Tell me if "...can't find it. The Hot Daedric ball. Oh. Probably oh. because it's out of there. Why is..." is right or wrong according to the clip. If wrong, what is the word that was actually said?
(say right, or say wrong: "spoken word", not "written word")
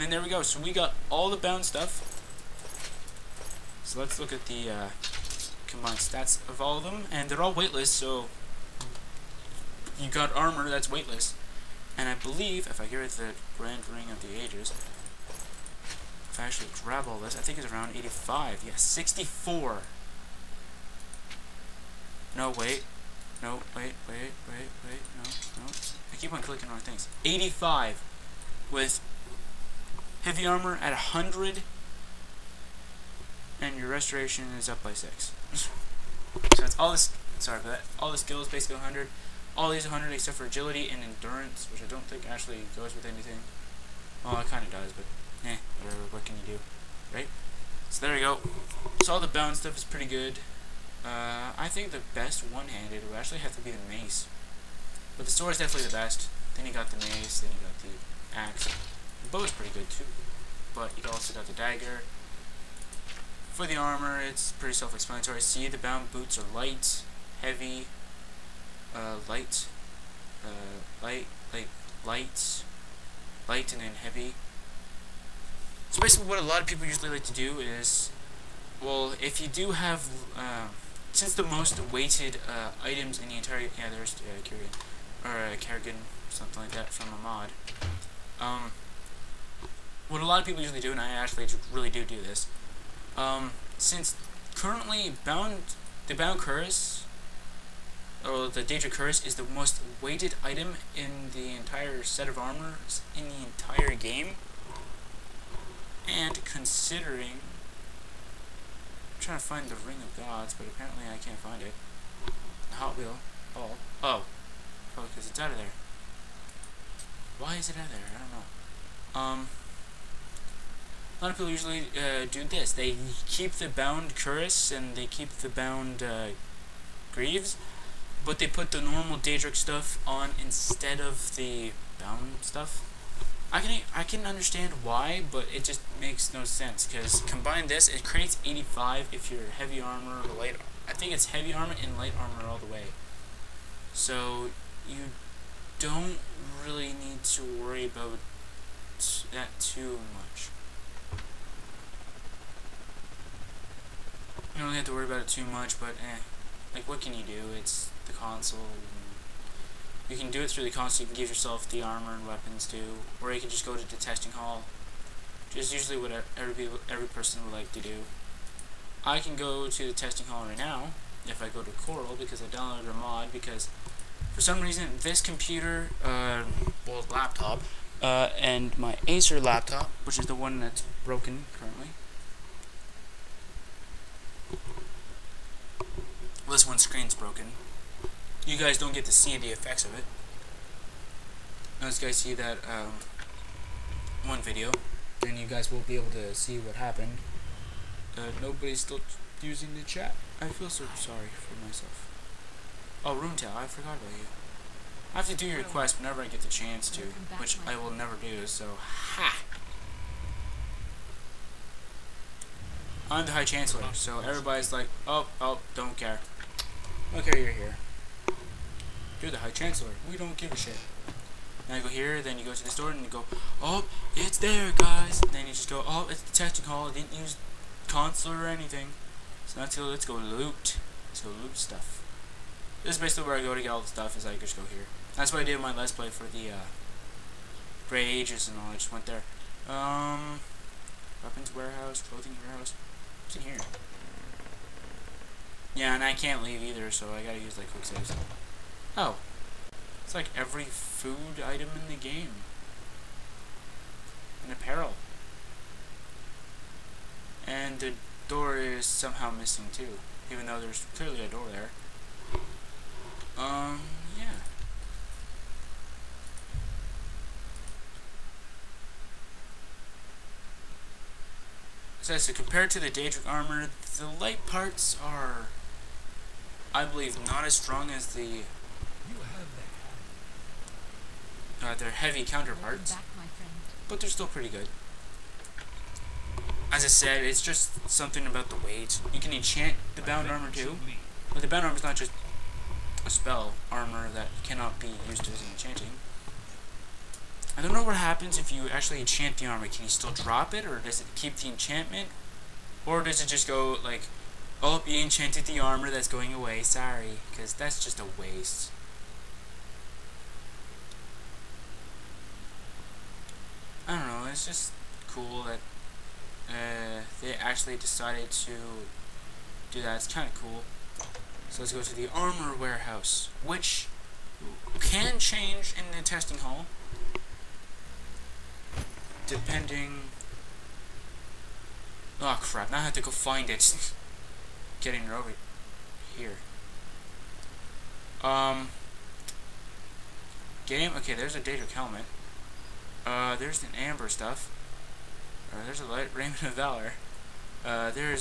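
wrong: "Wheel", not "Daedric".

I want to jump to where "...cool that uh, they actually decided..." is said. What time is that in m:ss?
5:15.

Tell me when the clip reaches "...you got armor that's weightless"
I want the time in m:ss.
0:09.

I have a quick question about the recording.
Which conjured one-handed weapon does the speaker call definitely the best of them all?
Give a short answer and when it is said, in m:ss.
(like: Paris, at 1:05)
The sword, at 0:55.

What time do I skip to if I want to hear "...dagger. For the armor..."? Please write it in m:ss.
1:01.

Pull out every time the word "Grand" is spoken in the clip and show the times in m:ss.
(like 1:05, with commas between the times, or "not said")
0:13.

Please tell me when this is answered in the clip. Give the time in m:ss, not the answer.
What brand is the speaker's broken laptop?
2:59.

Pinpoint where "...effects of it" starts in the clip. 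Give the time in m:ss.
3:09.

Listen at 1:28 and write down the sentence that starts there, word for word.
Um, what a lot of people usually do, and I actually really do do this.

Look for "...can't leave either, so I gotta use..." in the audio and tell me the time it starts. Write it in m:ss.
4:06.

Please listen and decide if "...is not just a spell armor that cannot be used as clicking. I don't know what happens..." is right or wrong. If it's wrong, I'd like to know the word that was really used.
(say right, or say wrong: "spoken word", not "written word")
wrong: "enchanting", not "clicking".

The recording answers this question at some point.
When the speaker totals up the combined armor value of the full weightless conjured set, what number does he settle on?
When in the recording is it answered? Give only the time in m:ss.
0:27.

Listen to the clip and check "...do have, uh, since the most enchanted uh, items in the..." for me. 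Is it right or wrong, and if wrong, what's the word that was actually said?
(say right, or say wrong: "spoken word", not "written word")
wrong: "weighted", not "enchanted".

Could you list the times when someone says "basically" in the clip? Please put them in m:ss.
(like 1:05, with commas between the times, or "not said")
0:38, 1:16, 3:53.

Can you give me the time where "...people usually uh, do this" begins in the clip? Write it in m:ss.
2:01.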